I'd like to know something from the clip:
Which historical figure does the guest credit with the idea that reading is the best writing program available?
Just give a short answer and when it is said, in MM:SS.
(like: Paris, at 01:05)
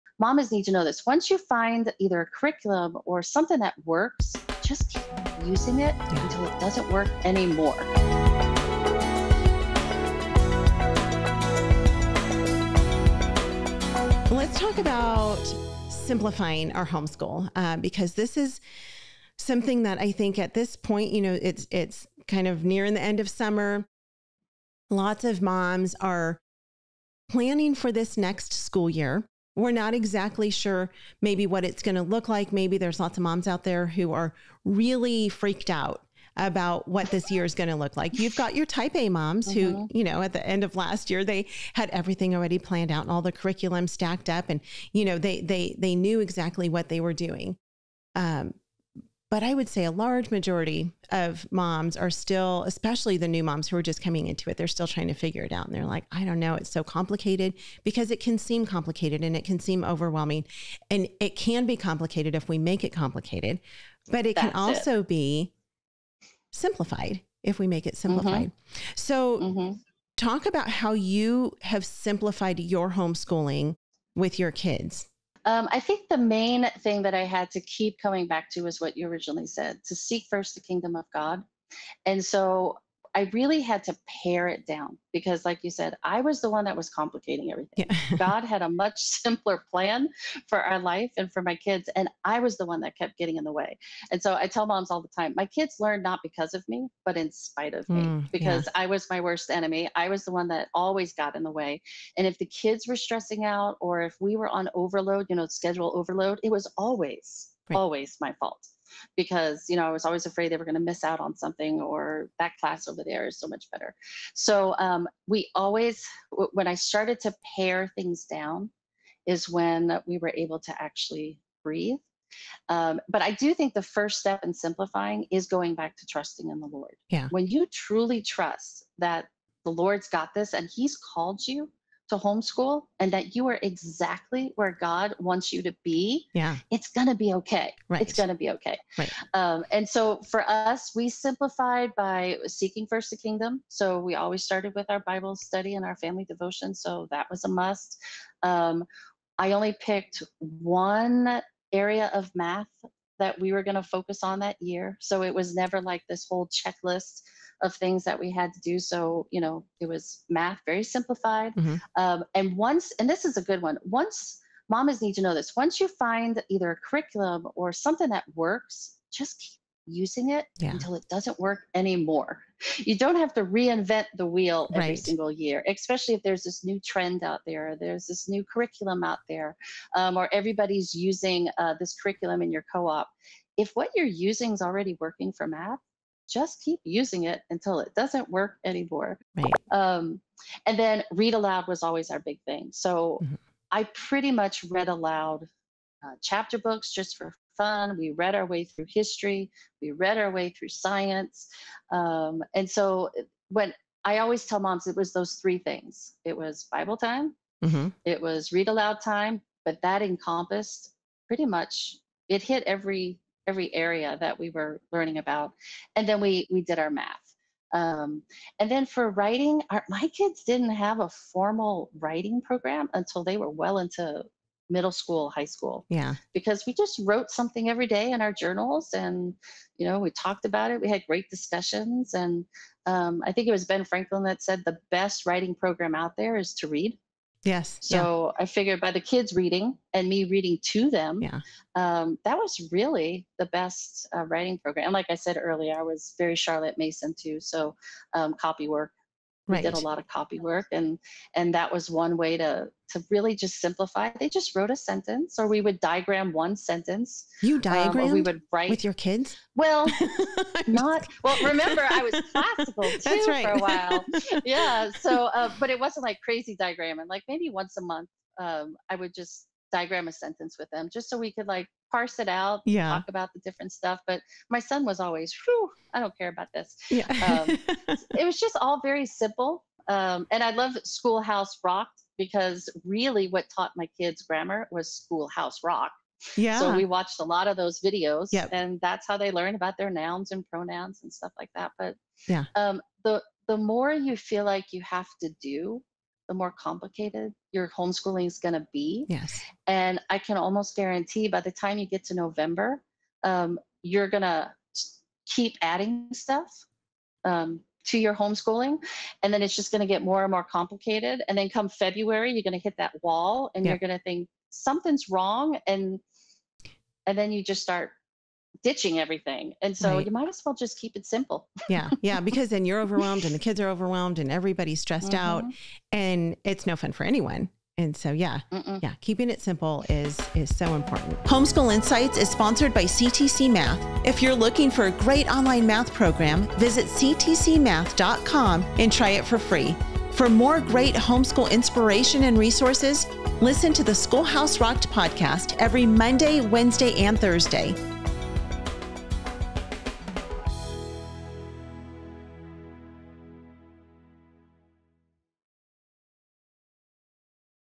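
Ben Franklin, at 03:53.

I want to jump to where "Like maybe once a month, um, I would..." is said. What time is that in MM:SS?
04:27.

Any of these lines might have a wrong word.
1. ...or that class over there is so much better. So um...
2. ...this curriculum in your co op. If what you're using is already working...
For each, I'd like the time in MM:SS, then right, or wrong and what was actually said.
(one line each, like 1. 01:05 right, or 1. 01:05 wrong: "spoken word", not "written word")
1. 01:51 right
2. 03:01 right.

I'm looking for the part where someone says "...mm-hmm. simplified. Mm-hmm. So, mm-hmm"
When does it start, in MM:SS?
01:07.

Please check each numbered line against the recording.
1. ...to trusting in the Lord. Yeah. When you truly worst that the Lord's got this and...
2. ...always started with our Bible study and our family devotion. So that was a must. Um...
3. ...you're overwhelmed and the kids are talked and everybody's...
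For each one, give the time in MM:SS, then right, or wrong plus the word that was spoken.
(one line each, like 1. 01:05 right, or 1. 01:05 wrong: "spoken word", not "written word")
1. 02:05 wrong: "trust", not "worst"
2. 02:24 right
3. 05:22 wrong: "overwhelmed", not "talked".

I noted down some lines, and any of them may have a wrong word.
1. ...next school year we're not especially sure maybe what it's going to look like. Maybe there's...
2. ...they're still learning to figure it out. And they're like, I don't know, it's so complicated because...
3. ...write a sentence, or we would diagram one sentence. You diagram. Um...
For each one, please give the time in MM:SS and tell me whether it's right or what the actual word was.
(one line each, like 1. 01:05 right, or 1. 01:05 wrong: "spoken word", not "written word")
1. 00:28 wrong: "exactly", not "especially"
2. 00:54 wrong: "trying", not "learning"
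3. 04:14 wrong: "wrote", not "write".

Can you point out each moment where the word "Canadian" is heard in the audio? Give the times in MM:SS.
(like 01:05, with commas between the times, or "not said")
not said.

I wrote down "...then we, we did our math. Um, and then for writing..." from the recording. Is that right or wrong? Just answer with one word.
right.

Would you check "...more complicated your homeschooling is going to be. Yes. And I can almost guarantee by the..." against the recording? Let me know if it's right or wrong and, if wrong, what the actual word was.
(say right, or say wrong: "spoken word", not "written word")
right.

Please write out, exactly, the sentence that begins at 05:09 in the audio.
And then it's just going to get more and more complicated.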